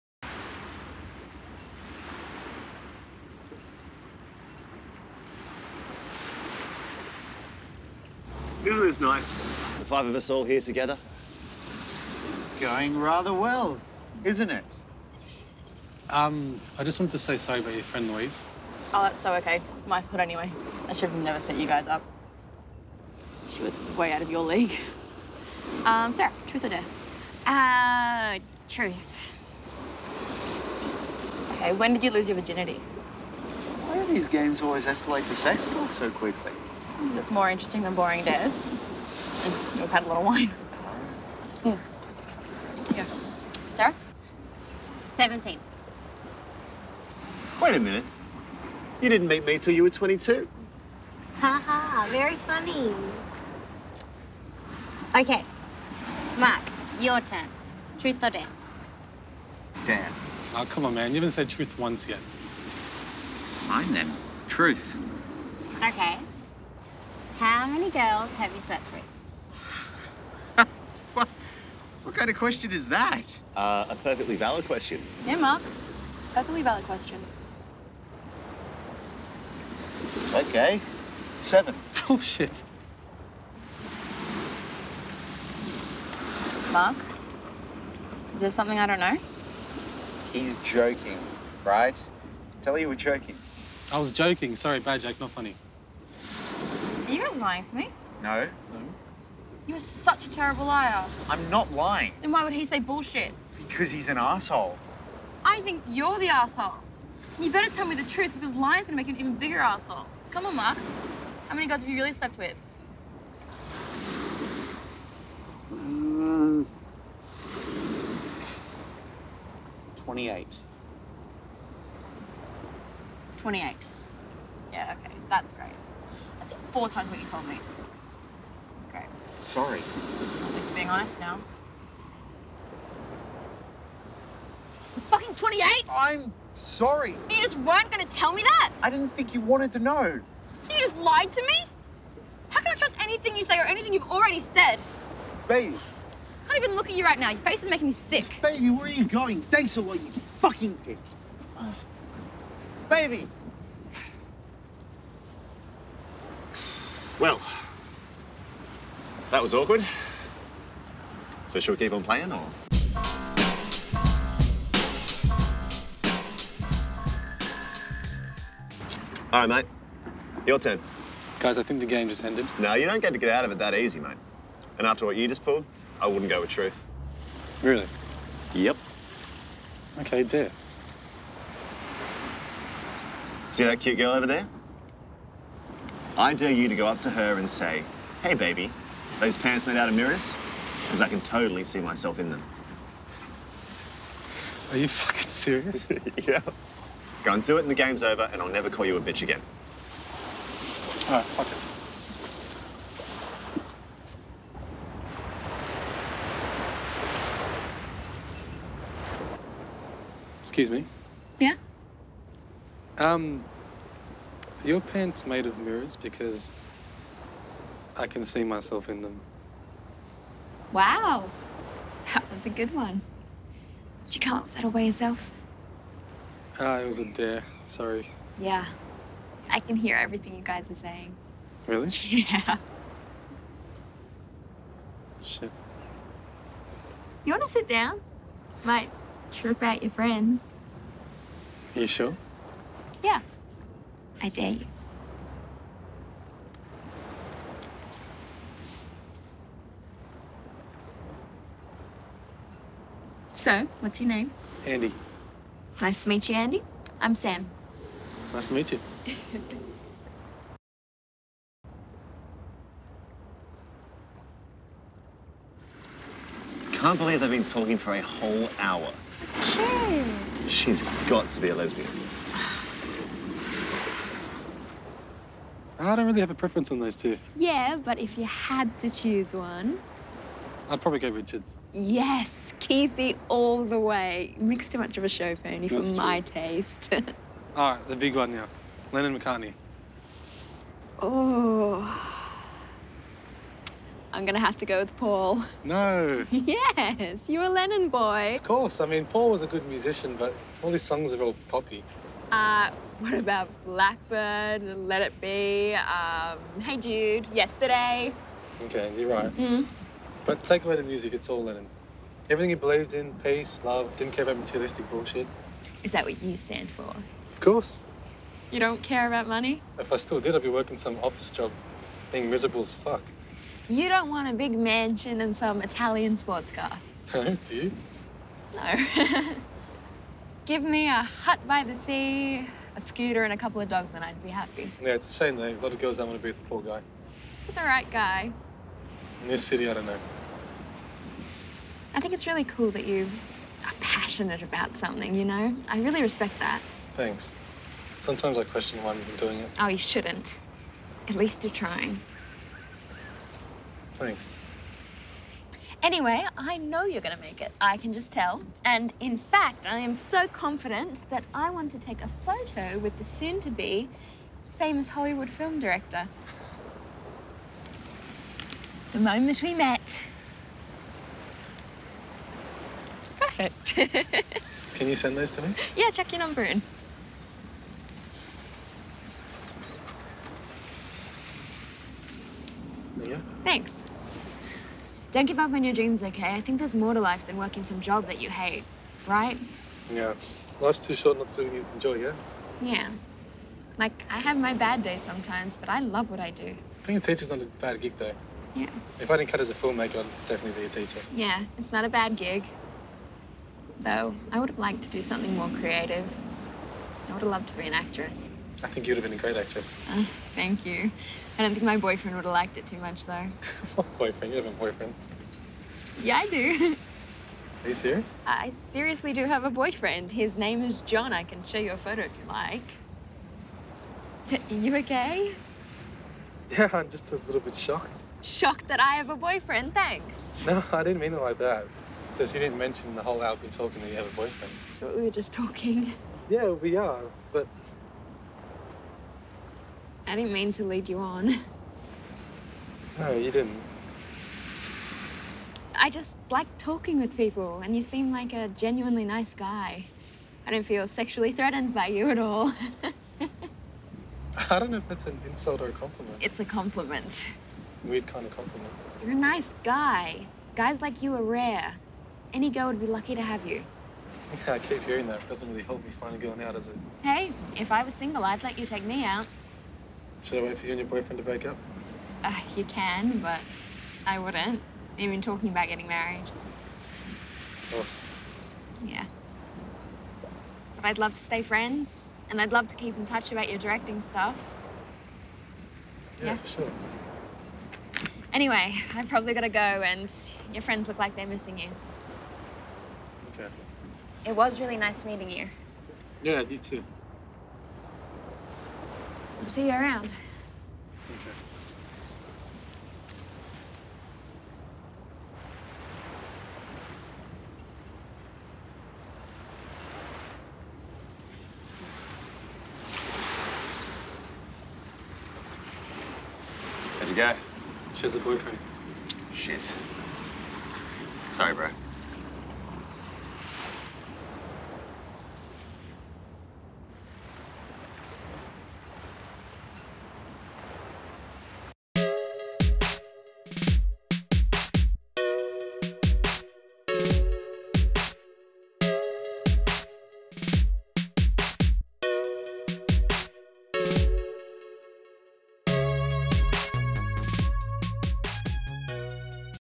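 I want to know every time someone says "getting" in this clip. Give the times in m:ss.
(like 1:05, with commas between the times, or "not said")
7:55.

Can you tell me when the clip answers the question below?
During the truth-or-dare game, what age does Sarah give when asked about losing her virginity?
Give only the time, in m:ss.
0:45.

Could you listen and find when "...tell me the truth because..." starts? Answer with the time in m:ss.
1:47.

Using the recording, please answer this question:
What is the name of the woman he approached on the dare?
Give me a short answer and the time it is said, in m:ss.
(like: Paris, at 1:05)
Sam, at 4:17.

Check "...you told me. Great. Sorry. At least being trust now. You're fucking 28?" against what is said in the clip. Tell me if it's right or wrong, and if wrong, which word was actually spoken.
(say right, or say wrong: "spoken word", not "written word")
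wrong: "honest", not "trust".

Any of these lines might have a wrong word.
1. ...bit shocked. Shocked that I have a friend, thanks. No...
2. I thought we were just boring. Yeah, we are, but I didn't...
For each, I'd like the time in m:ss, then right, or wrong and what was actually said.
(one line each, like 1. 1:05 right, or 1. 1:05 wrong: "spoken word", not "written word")
1. 7:07 wrong: "boyfriend", not "friend"
2. 7:14 wrong: "talking", not "boring".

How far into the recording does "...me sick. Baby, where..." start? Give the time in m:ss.
2:27.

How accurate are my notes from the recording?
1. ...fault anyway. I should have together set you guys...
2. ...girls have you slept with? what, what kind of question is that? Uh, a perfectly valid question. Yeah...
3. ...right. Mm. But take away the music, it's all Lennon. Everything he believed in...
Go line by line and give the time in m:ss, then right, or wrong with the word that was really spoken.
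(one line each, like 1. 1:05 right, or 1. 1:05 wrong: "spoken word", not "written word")
1. 0:20 wrong: "never", not "together"
2. 1:07 right
3. 5:09 right.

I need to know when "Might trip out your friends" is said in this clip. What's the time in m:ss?
3:58.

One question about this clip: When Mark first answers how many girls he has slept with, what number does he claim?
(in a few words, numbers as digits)
7.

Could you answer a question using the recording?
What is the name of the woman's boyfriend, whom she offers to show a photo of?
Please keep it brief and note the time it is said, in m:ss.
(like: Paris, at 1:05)
John, at 7:00.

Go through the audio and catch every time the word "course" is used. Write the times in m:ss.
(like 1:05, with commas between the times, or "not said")
4:58, 5:17.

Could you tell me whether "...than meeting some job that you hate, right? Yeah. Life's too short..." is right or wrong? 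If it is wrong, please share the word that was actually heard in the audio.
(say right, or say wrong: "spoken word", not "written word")
wrong: "working", not "meeting".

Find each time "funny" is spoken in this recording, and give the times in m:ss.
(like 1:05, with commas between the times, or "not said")
0:52, 1:35.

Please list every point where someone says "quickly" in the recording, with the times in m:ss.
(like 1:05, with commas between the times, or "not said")
0:36.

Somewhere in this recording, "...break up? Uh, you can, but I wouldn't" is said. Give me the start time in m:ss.
7:51.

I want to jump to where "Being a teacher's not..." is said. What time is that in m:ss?
6:36.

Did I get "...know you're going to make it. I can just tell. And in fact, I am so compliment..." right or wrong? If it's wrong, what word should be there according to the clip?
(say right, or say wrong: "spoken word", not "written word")
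wrong: "confident", not "compliment".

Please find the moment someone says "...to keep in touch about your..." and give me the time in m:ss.
8:02.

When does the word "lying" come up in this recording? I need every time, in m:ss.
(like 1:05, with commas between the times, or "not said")
1:37, 1:41, 1:48.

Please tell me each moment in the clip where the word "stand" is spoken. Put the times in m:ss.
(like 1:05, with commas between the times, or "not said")
5:16.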